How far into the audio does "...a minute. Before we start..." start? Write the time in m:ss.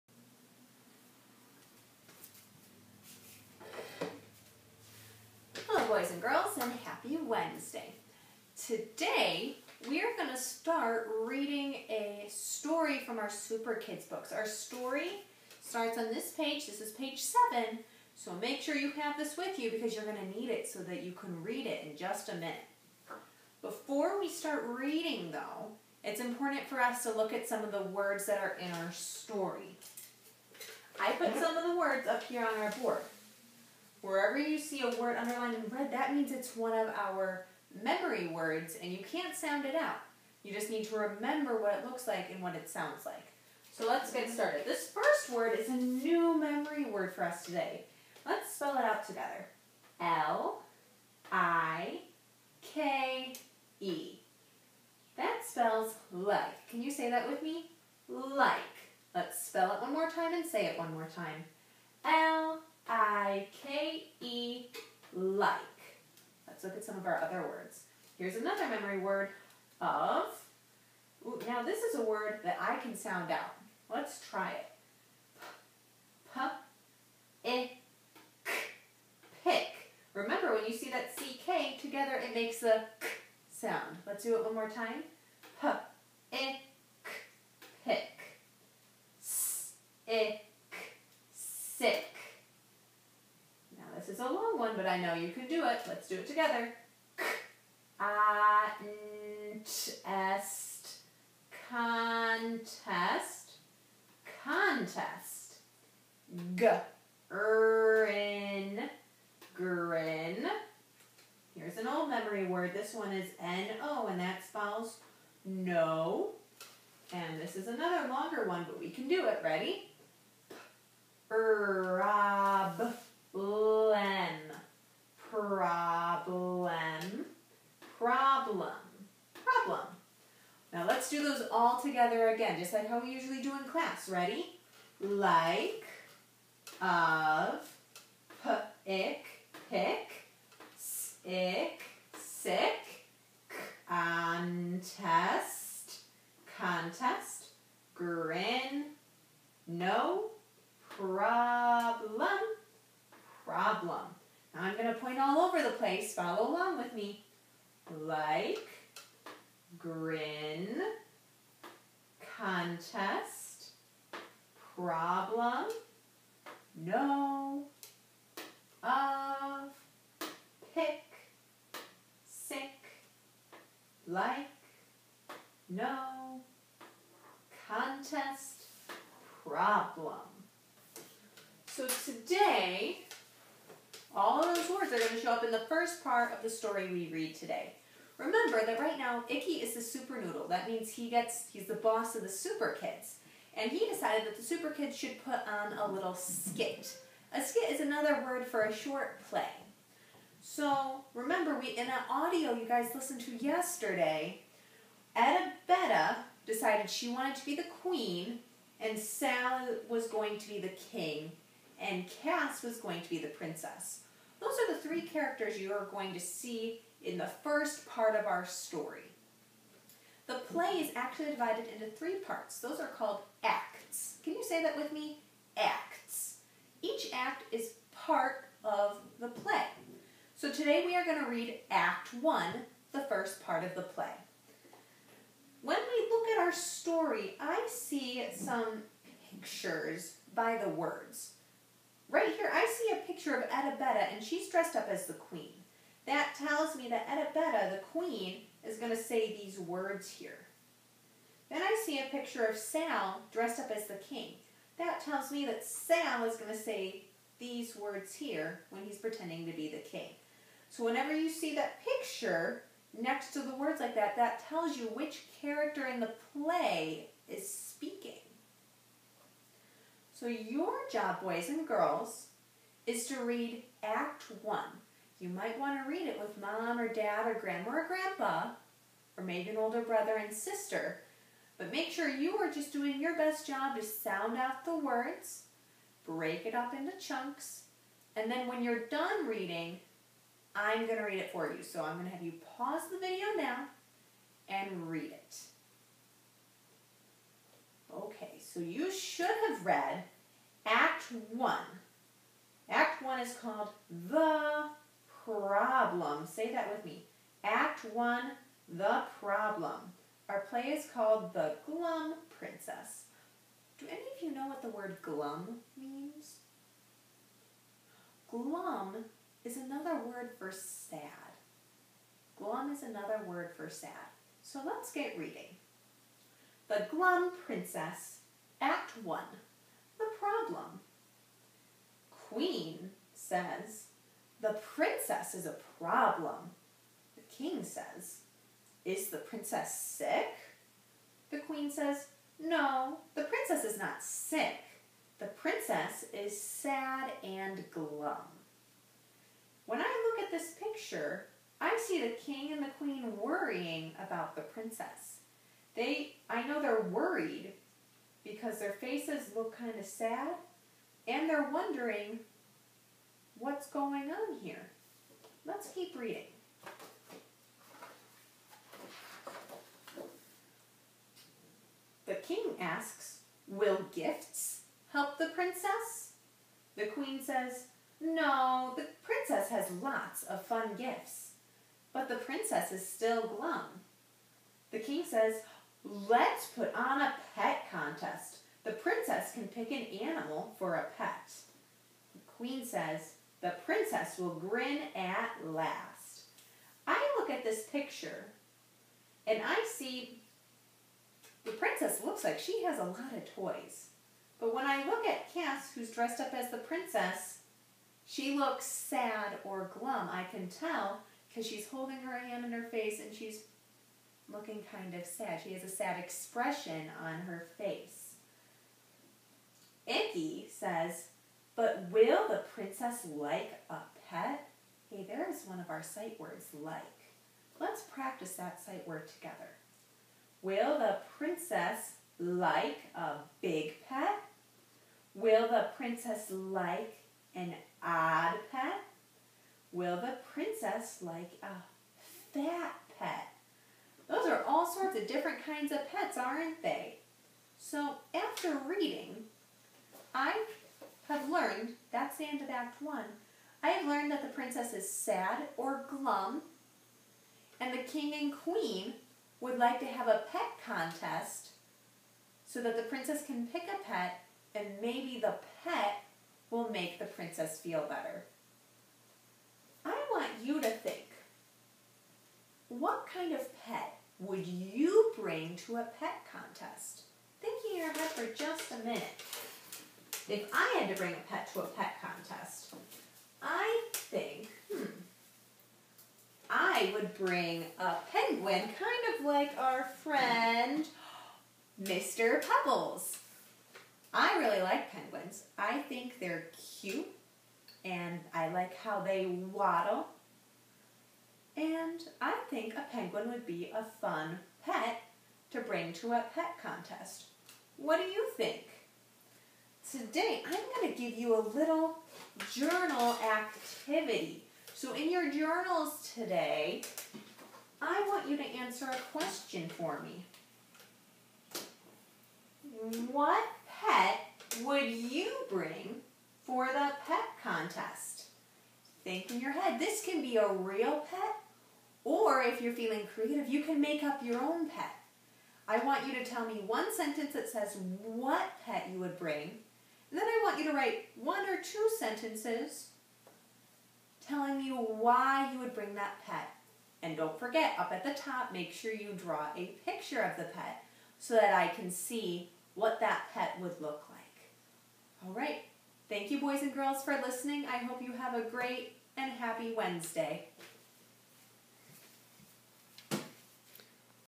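0:22.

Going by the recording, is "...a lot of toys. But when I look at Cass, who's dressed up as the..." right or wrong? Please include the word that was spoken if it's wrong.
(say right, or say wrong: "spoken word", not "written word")
right.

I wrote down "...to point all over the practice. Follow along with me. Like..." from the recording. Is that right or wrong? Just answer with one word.
wrong.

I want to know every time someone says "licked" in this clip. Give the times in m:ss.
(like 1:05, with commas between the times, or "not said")
not said.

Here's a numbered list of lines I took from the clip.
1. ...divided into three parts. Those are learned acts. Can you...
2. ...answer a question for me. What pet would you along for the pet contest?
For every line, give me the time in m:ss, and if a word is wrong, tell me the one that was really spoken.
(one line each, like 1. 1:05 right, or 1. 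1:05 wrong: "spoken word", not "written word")
1. 3:41 wrong: "called", not "learned"
2. 8:38 wrong: "bring", not "along".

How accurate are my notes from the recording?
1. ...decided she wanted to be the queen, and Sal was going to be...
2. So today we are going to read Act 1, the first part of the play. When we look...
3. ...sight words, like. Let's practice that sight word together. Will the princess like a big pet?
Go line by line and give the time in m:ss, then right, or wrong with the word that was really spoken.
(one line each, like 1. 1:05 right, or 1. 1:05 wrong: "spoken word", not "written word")
1. 3:26 right
2. 3:50 right
3. 7:05 right.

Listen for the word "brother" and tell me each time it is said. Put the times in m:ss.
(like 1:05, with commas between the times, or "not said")
4:39.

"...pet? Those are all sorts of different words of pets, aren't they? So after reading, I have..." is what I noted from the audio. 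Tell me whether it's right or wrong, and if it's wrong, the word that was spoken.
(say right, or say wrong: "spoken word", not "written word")
wrong: "kinds", not "words".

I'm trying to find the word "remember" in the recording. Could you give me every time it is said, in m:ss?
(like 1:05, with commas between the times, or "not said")
0:40, 1:20, 3:08, 3:21.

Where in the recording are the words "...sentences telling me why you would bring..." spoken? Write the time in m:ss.
9:01.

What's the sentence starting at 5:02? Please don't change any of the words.
Act 1 is called The problem.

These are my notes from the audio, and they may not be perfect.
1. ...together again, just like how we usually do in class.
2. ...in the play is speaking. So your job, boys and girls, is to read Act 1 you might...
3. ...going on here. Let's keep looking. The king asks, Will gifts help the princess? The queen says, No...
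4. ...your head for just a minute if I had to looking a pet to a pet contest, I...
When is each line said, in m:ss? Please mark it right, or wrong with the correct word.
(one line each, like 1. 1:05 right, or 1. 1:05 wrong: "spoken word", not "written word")
1. 2:11 right
2. 4:25 right
3. 6:03 wrong: "reading", not "looking"
4. 7:57 wrong: "bring", not "looking".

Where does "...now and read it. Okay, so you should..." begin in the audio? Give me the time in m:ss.
4:53.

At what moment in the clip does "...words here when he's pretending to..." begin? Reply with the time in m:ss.
4:17.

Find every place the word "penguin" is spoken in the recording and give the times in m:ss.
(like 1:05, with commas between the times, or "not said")
8:08, 8:14, 8:22.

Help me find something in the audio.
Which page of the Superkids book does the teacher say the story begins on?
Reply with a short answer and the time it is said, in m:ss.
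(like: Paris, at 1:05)
7, at 0:16.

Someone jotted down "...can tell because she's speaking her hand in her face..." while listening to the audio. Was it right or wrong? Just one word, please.
wrong.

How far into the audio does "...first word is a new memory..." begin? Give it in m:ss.
0:44.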